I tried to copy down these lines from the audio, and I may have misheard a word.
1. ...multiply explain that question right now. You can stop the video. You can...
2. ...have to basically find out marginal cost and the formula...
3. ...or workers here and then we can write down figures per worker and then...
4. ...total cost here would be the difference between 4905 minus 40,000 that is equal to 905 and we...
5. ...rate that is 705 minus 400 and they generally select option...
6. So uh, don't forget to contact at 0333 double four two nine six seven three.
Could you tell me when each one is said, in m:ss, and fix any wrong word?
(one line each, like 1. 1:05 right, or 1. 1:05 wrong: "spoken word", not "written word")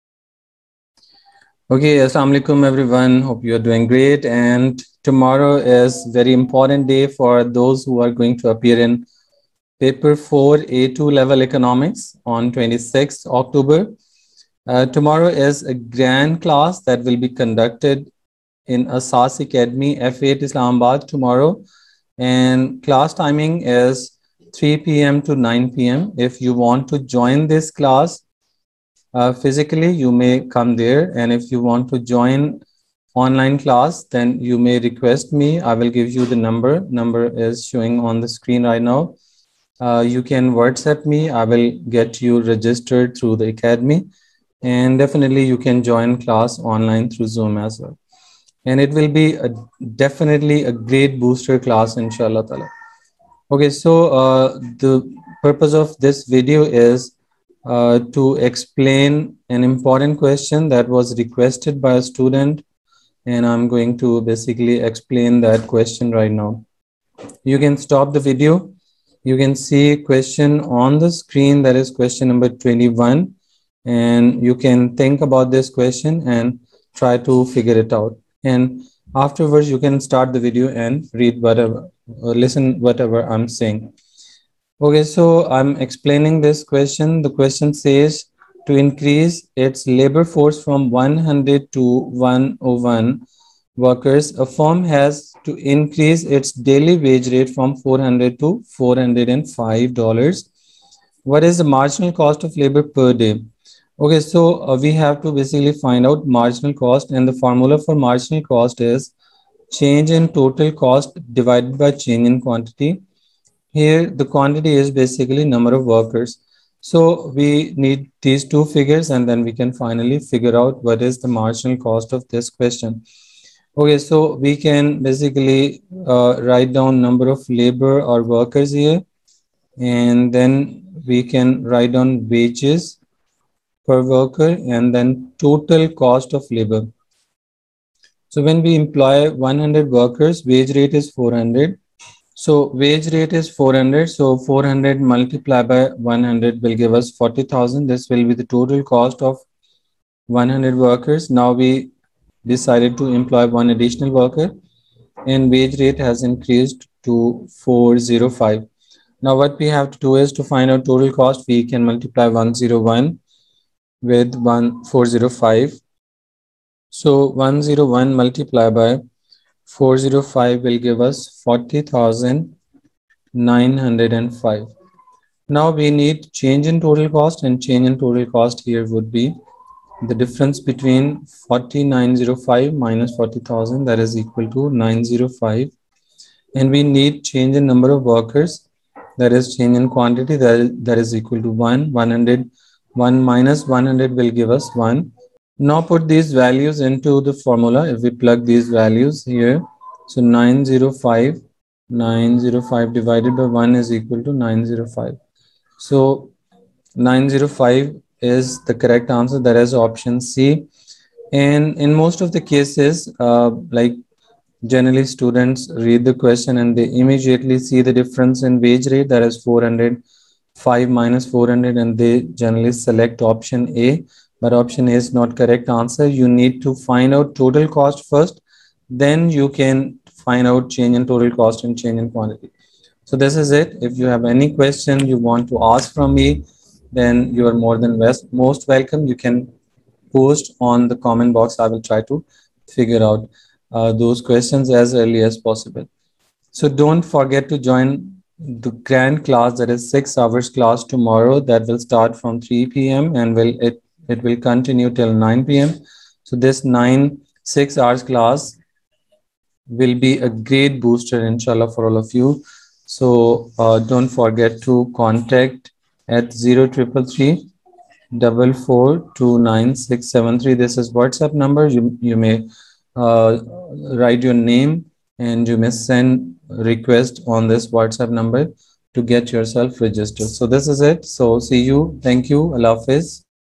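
1. 1:04 wrong: "basically", not "multiply"
2. 1:44 right
3. 2:08 wrong: "wages", not "figures"
4. 2:57 right
5. 3:38 wrong: "405", not "705"
6. 4:22 right.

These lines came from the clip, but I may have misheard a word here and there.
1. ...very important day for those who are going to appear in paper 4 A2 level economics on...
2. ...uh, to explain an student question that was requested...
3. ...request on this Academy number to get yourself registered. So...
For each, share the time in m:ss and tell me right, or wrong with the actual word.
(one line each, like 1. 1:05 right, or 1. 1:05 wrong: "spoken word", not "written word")
1. 0:06 right
2. 0:57 wrong: "important", not "student"
3. 4:36 wrong: "WhatsApp", not "Academy".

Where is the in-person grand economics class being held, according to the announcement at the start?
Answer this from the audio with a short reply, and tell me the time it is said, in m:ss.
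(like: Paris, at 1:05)
Asas Academy F8 Islamabad, at 0:18.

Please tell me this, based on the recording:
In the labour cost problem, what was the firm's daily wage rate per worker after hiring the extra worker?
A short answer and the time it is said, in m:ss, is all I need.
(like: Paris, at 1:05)
$405, at 1:38.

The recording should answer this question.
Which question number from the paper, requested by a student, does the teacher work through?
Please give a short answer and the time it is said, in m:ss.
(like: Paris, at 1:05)
21, at 1:12.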